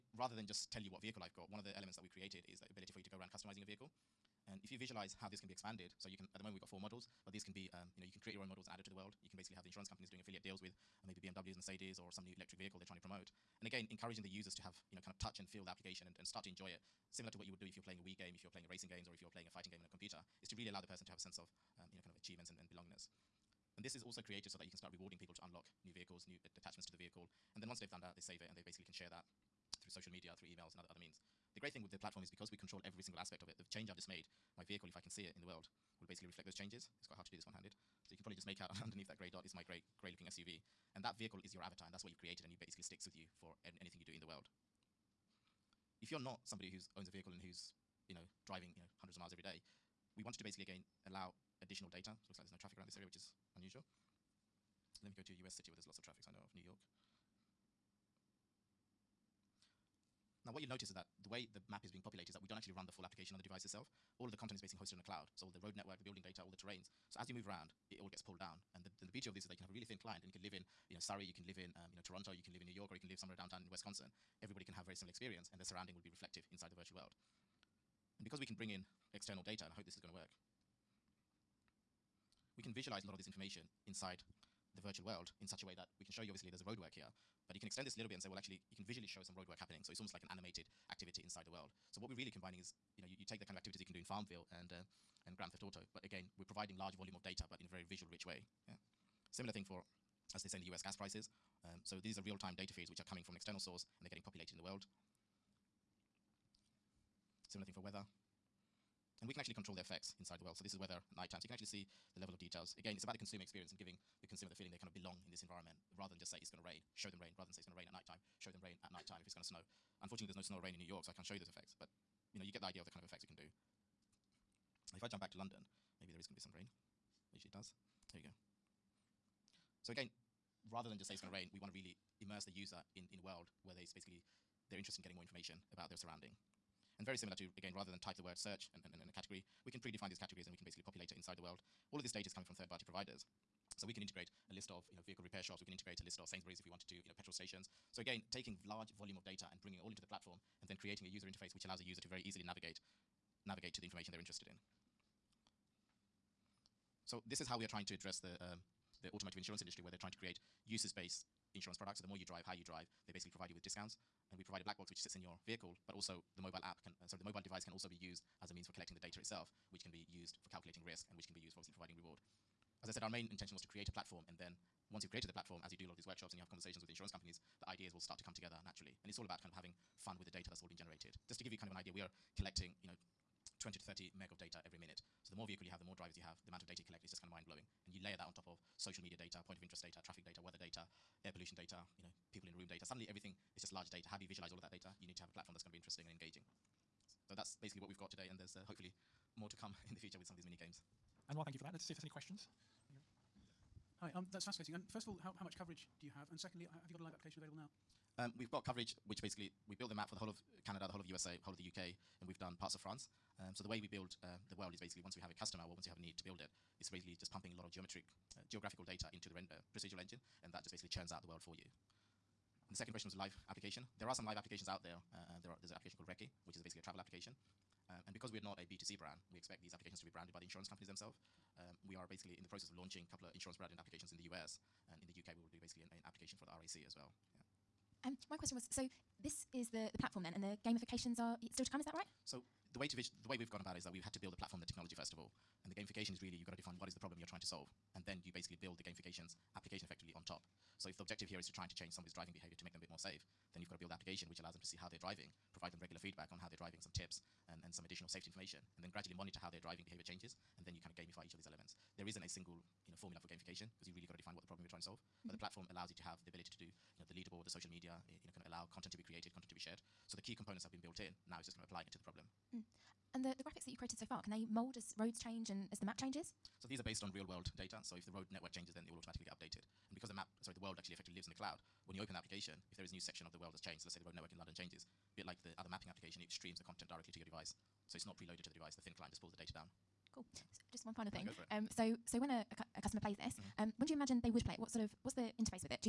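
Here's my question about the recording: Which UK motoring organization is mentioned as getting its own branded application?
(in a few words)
RAC.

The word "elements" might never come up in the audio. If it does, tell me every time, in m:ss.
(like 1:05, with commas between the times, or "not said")
0:01, 4:21.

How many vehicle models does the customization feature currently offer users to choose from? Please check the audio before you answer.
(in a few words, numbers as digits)
4.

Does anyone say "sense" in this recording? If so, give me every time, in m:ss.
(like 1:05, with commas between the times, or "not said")
0:21.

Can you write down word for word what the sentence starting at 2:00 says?
Unfortunately, there's no snow or rain in New York, so I can't show you those effects.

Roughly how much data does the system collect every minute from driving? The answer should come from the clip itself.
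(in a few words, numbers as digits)
20 to 30 meg.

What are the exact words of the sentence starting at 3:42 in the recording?
And the second question was live application.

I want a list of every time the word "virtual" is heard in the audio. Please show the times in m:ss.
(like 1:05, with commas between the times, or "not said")
1:16, 1:24.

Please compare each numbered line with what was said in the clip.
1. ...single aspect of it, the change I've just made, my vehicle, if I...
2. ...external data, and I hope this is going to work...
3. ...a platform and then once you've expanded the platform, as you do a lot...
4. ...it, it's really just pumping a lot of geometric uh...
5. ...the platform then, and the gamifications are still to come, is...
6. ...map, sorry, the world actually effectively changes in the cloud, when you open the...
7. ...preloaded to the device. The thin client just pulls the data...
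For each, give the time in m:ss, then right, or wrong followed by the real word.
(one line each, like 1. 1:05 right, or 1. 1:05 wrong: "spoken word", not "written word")
1. 0:33 right
2. 1:19 right
3. 2:53 wrong: "created", not "expanded"
4. 3:36 right
5. 3:59 right
6. 4:40 wrong: "lives", not "changes"
7. 4:48 right.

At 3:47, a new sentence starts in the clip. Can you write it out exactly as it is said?
Uh, and because we're not a B2C brand, we expect these applications to be branded by the insurance companies themselves.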